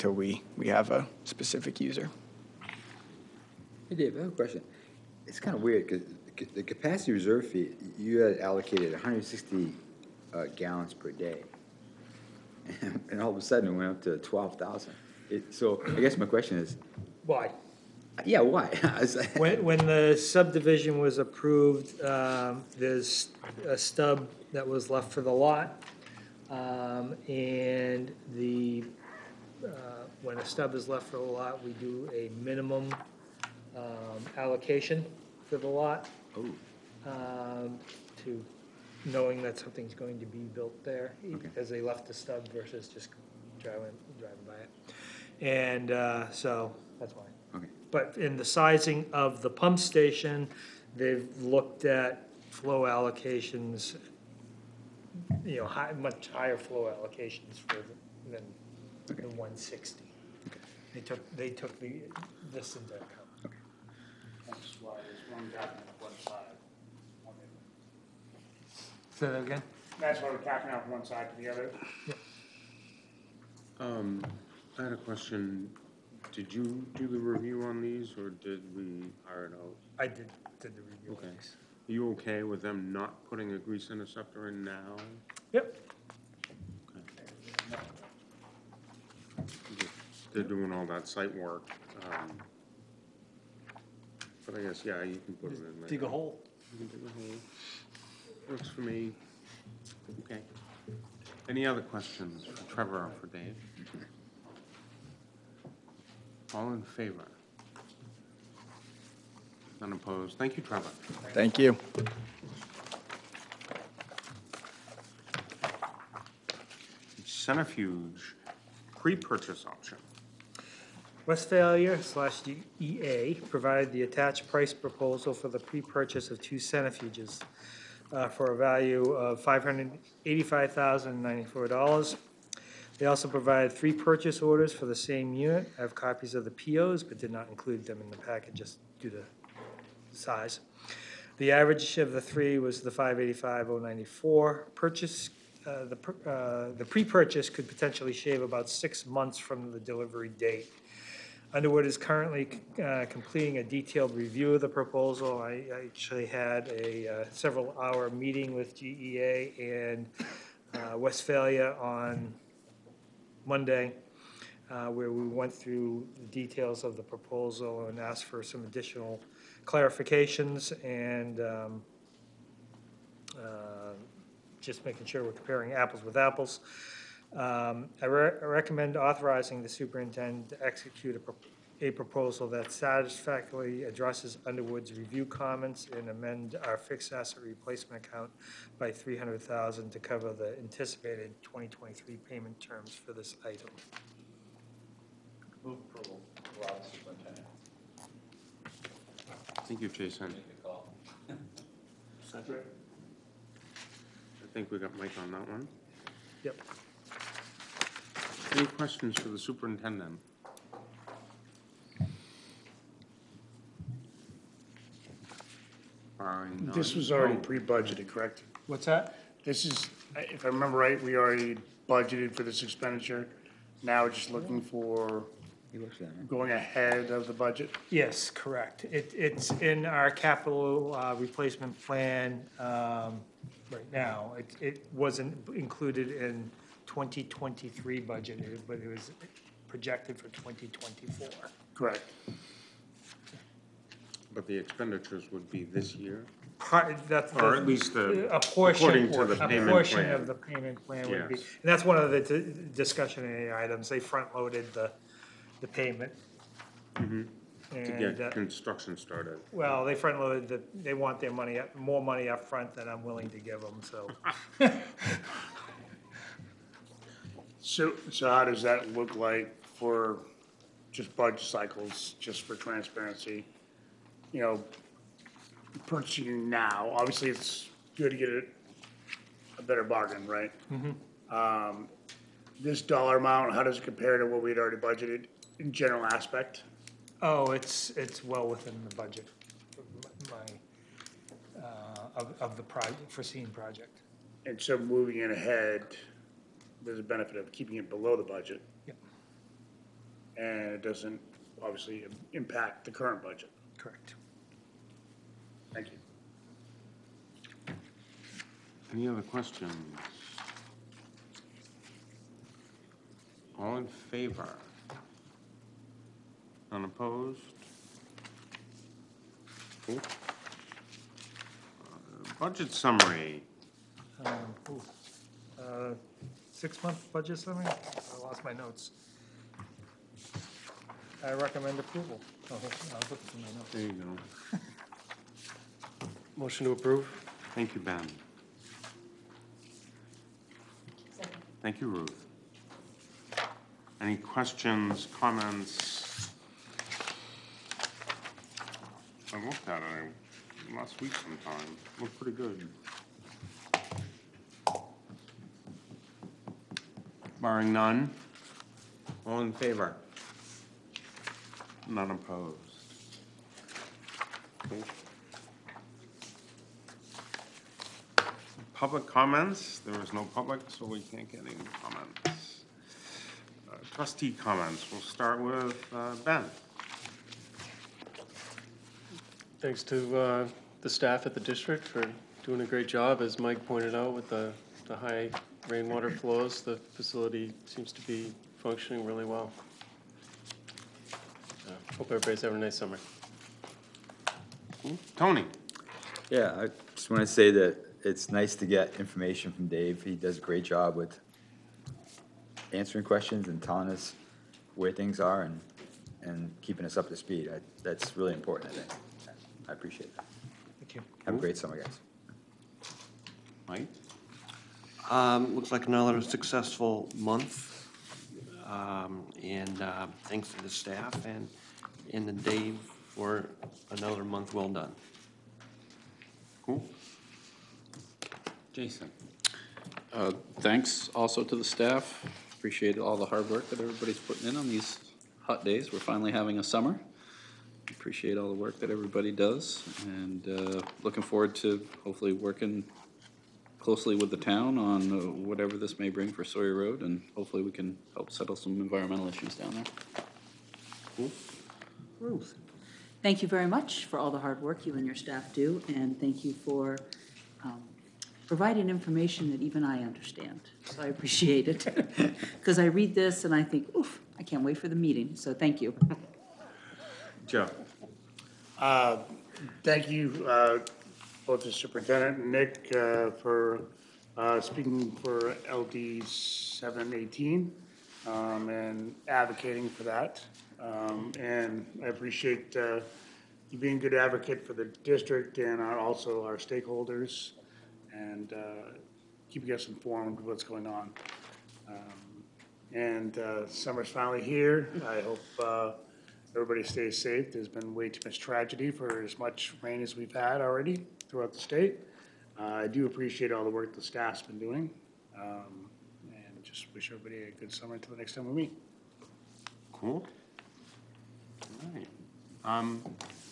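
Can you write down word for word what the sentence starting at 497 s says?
There's been way too much tragedy for as much rain as we've had already throughout the state.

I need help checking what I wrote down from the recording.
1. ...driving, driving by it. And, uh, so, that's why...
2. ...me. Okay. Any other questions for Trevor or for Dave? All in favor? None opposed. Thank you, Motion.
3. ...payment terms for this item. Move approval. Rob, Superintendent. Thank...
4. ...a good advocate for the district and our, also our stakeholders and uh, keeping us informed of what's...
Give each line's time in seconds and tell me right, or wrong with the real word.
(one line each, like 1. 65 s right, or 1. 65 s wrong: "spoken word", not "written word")
1. 43 s right
2. 98 s wrong: "Trevor", not "Motion"
3. 192 s right
4. 483 s right.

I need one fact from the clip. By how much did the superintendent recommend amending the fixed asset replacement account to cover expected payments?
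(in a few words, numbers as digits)
300,000.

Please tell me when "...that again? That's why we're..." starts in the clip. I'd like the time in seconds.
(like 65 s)
69 s.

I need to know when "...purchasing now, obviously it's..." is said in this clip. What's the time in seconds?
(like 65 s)
275 s.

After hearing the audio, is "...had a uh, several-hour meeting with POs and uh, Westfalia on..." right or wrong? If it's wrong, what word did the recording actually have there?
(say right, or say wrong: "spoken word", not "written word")
wrong: "GEA", not "POs".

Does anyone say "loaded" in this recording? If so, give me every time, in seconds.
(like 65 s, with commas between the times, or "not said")
253 s, 259 s.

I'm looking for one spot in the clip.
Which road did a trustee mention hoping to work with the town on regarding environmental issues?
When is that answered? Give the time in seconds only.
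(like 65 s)
446 s.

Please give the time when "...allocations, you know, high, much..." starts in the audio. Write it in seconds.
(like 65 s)
52 s.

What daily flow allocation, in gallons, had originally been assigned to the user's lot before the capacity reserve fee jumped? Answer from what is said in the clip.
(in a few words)
160.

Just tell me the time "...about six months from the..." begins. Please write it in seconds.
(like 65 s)
148 s.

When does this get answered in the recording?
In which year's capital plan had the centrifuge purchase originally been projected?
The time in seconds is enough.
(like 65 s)
240 s.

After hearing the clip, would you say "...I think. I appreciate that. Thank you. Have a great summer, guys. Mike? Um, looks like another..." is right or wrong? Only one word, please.
right.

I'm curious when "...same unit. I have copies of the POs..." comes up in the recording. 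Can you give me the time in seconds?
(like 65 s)
134 s.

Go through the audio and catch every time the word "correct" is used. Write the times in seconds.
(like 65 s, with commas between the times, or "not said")
218 s, 228 s, 241 s, 303 s.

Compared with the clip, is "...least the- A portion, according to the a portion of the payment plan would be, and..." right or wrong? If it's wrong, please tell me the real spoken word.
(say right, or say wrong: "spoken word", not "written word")
right.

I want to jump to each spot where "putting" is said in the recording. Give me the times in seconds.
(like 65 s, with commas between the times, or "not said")
83 s, 434 s.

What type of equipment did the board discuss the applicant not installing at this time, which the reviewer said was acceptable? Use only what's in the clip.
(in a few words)
grease interceptor.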